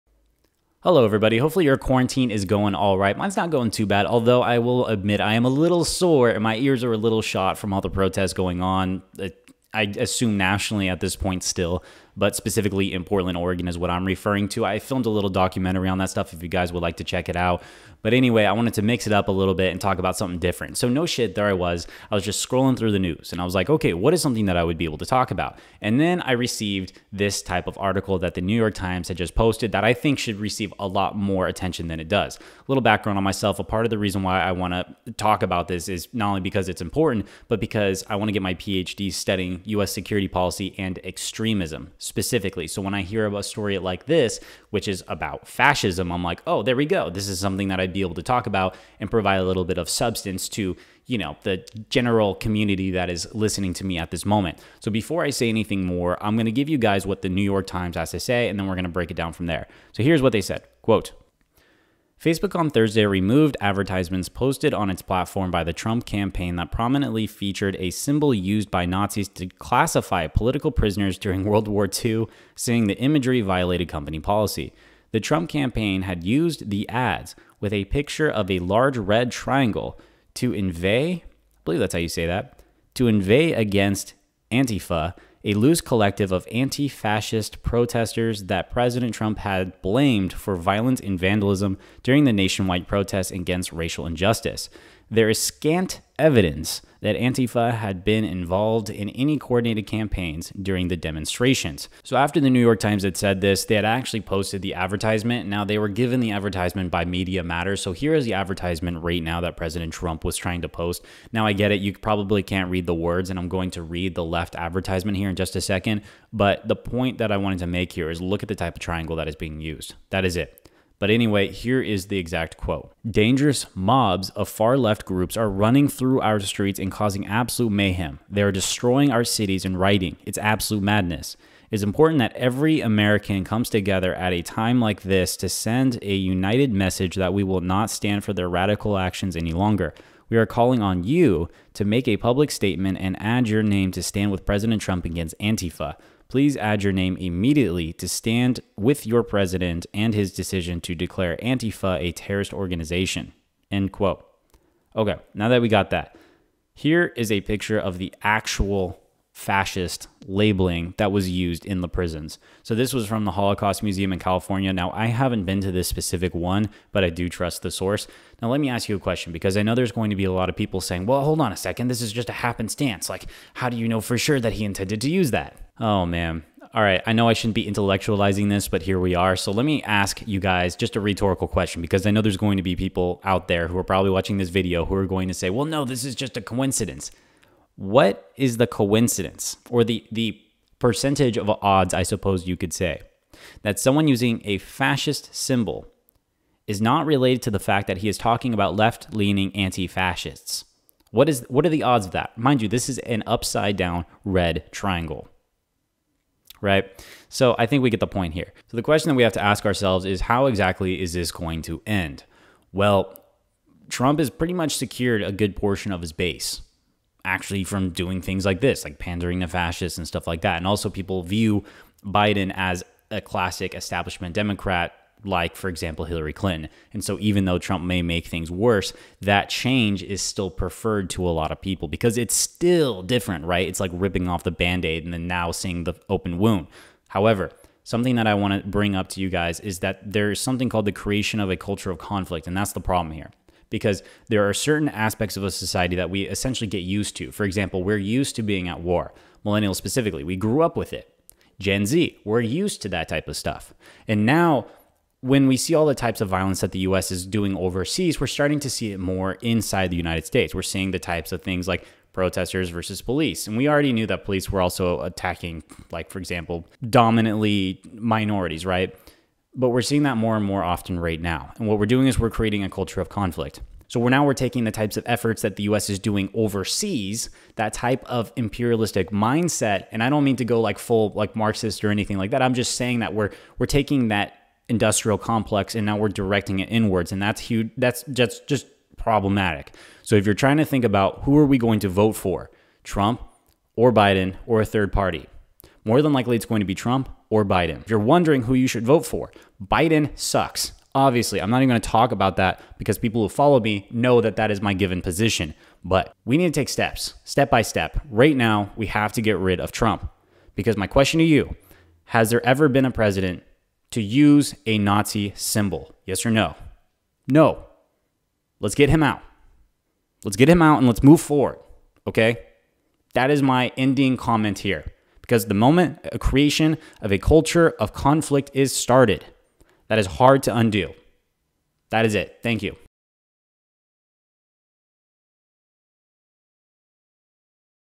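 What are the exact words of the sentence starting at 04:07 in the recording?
For example, we're used to being at war, millennials specifically.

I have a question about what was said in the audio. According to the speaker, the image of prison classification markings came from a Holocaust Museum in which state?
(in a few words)
California.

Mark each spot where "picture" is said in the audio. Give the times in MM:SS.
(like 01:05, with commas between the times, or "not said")
01:17, 02:37.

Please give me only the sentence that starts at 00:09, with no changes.
I assume nationally at this point, still but specifically in Portland, Oregon is what I'm referring to.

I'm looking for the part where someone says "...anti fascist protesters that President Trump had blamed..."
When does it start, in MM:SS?
01:26.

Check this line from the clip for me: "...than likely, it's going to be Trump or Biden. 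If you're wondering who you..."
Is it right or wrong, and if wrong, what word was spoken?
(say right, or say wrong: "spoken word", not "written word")
right.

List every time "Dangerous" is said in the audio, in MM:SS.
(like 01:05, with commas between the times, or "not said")
02:03.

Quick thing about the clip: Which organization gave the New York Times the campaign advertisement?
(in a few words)
Media Matters.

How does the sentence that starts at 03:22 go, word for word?
Mind you, this is an upside down red triangle right?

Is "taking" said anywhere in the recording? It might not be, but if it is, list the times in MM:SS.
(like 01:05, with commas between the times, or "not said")
04:34, 04:43.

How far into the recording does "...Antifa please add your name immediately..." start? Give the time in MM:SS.
02:25.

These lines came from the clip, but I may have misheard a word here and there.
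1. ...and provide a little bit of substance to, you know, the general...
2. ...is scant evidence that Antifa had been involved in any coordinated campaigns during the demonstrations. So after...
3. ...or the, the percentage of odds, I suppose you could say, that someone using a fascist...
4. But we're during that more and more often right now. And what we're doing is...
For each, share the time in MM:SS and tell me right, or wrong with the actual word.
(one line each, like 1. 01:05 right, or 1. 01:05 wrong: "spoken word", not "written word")
1. 00:48 right
2. 01:35 right
3. 03:09 right
4. 04:29 wrong: "seeing", not "during".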